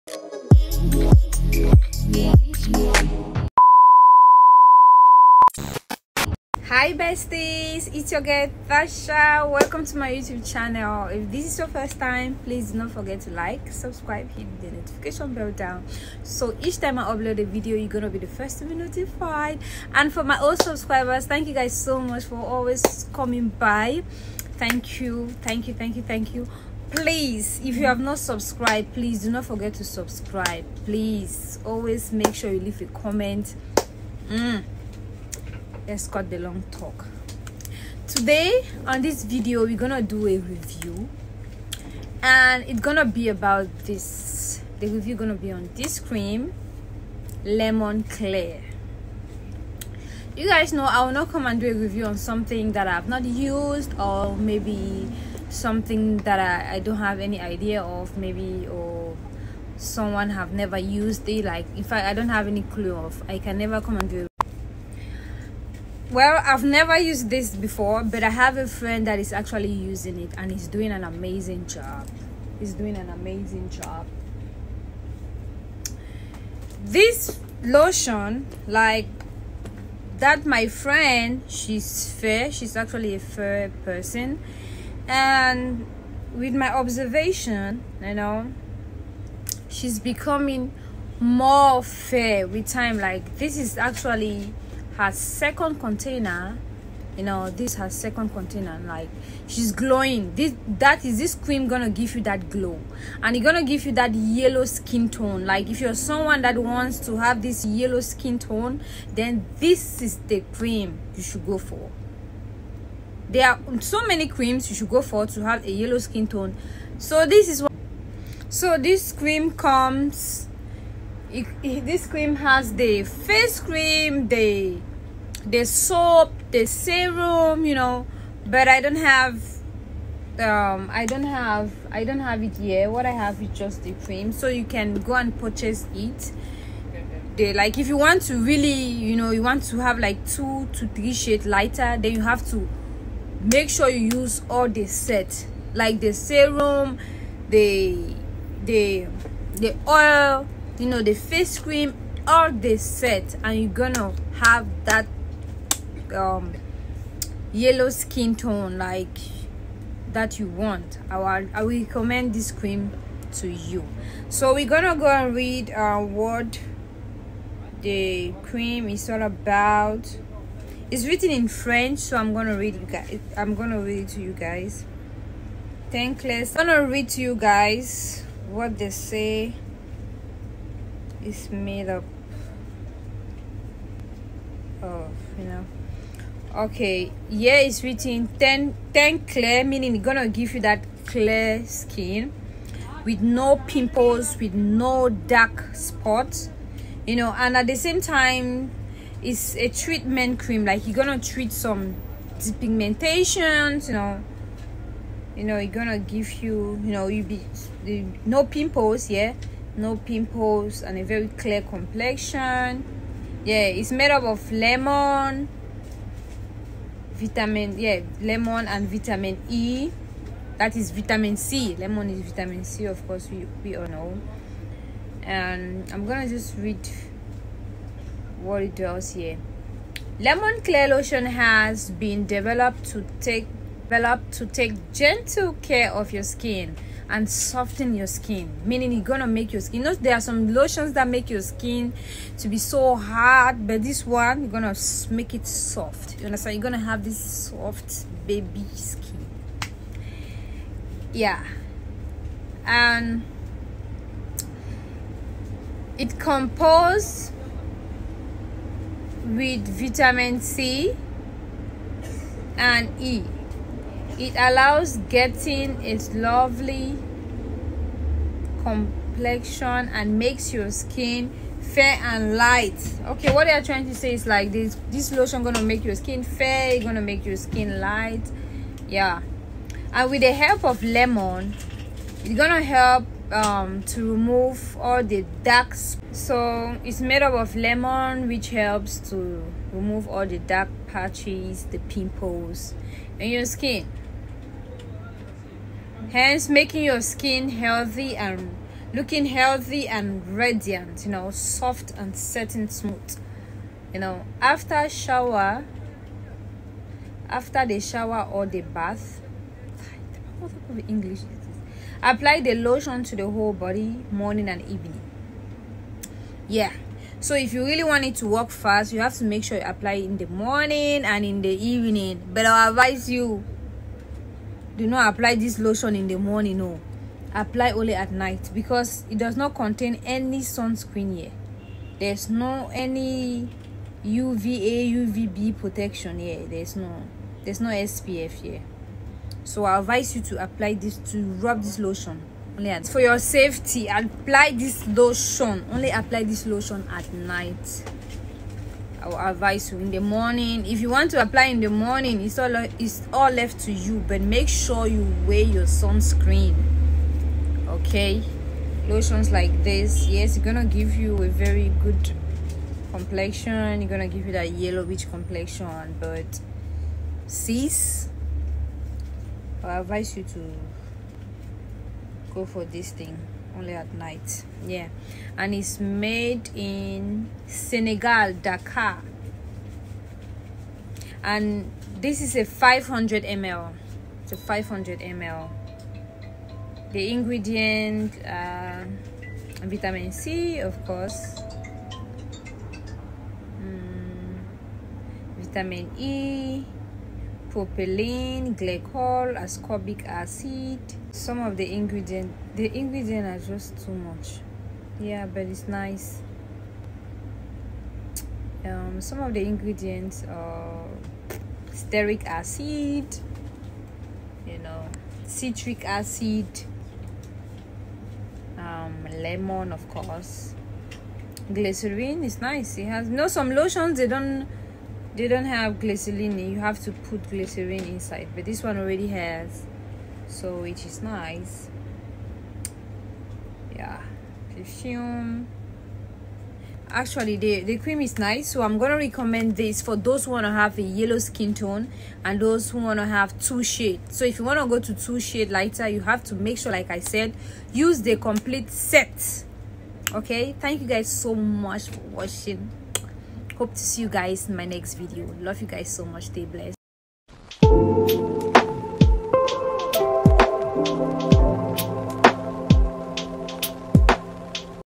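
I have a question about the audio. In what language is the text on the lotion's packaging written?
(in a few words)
French.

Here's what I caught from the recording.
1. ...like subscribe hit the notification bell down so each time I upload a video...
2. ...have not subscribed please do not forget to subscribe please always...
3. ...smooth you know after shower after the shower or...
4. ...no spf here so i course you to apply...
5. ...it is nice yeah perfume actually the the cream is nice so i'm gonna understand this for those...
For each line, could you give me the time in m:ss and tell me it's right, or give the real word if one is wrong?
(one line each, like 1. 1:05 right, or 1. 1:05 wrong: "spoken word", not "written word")
1. 0:13 right
2. 0:27 right
3. 5:02 right
4. 5:37 wrong: "advise", not "course"
5. 7:10 wrong: "recommend", not "understand".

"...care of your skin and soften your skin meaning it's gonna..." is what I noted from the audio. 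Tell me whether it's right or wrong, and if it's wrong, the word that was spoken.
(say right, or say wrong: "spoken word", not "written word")
right.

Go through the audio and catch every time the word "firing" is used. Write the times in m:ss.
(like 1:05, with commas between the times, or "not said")
not said.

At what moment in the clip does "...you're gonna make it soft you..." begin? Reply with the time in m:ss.
4:04.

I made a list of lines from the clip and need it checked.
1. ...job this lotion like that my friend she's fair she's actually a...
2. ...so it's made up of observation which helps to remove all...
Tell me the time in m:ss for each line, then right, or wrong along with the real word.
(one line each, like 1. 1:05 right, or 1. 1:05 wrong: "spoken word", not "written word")
1. 1:13 right
2. 4:46 wrong: "lemon", not "observation".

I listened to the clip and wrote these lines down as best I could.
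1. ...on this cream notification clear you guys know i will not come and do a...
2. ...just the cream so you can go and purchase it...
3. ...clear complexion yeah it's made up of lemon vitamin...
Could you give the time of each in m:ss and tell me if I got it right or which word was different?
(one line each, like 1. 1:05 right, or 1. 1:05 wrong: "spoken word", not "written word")
1. 0:45 wrong: "lemon", not "notification"
2. 2:13 right
3. 3:31 right.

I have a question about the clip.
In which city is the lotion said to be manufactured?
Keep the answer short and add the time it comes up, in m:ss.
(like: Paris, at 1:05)
Dakar, at 6:18.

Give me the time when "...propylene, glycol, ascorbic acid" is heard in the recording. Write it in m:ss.
6:37.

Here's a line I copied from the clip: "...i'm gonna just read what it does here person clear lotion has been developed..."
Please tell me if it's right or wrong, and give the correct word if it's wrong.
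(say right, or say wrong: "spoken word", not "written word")
wrong: "lemon", not "person".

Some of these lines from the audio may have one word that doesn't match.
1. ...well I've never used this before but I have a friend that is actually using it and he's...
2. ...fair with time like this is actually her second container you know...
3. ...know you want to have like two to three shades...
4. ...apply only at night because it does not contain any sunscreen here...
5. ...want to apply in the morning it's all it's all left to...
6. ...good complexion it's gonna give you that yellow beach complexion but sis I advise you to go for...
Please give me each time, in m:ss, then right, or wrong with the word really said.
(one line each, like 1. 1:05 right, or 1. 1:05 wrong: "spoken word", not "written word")
1. 1:06 right
2. 1:31 right
3. 2:19 right
4. 5:27 right
5. 5:50 right
6. 6:01 right.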